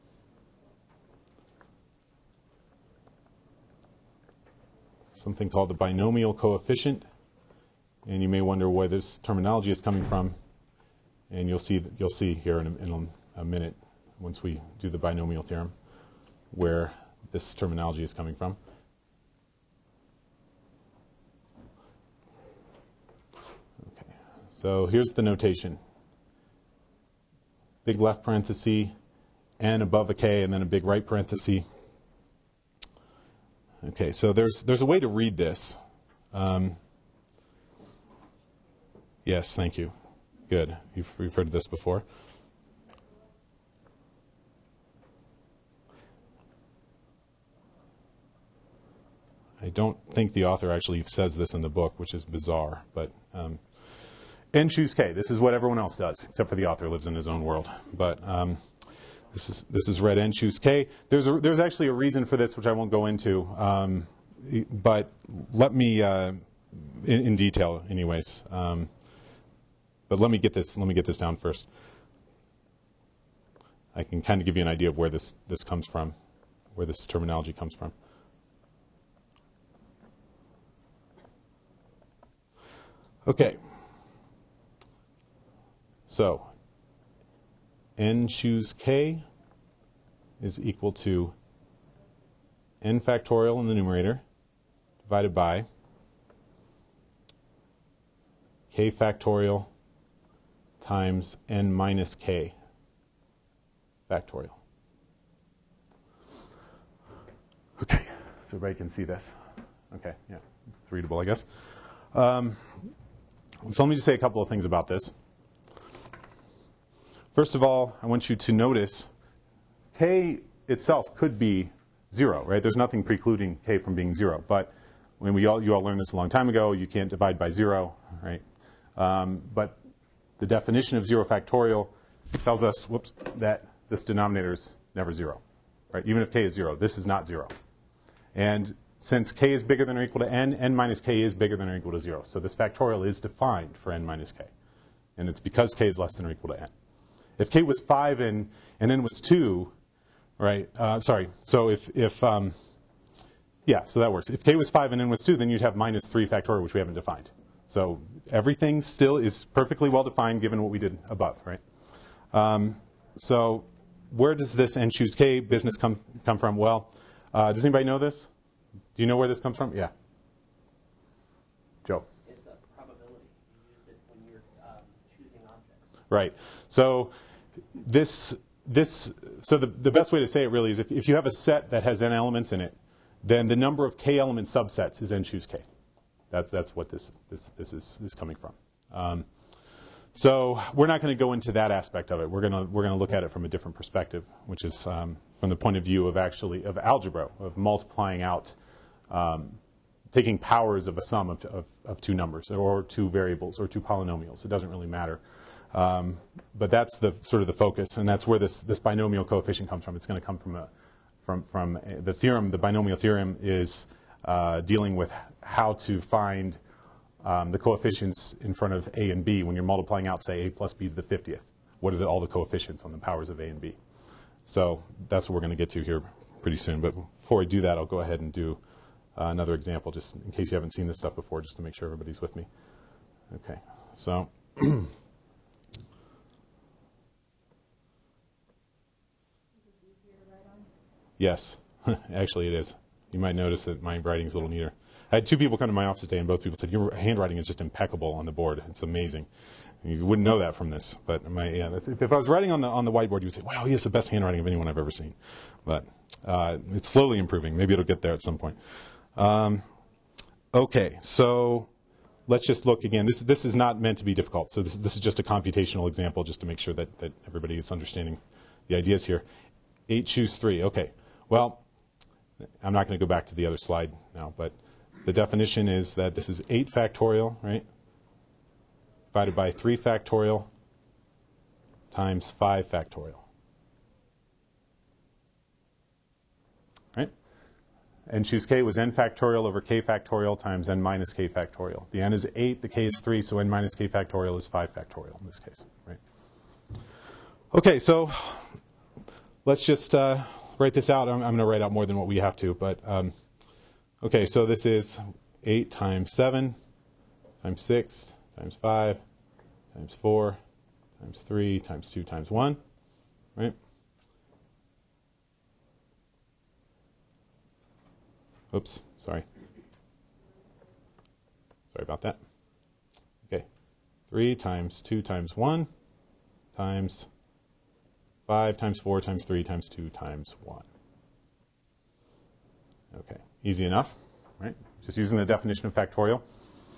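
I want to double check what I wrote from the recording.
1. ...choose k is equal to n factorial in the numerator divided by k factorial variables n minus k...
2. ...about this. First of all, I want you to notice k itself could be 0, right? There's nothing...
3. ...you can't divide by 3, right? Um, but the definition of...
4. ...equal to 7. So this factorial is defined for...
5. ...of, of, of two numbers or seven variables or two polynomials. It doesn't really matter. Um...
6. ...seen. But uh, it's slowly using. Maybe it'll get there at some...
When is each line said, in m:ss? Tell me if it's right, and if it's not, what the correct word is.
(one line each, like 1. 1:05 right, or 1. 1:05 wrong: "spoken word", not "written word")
1. 1:28 wrong: "times", not "variables"
2. 1:54 right
3. 2:06 wrong: "0", not "3"
4. 2:21 wrong: "0", not "7"
5. 3:21 wrong: "two", not "seven"
6. 4:14 wrong: "improving", not "using".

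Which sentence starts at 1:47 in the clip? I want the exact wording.
Okay, so everybody can see this.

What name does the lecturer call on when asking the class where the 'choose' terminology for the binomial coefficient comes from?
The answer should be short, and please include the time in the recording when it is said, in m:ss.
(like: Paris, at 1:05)
Joe, at 2:51.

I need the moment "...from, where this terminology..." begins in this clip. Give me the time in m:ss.
1:15.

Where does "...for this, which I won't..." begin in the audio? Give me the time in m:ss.
1:02.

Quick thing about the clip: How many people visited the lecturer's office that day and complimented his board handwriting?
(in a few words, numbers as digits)
2.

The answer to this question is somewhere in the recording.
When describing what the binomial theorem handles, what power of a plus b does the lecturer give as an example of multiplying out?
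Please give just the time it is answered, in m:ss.
3:41.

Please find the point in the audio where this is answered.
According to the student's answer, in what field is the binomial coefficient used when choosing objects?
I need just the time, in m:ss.
2:52.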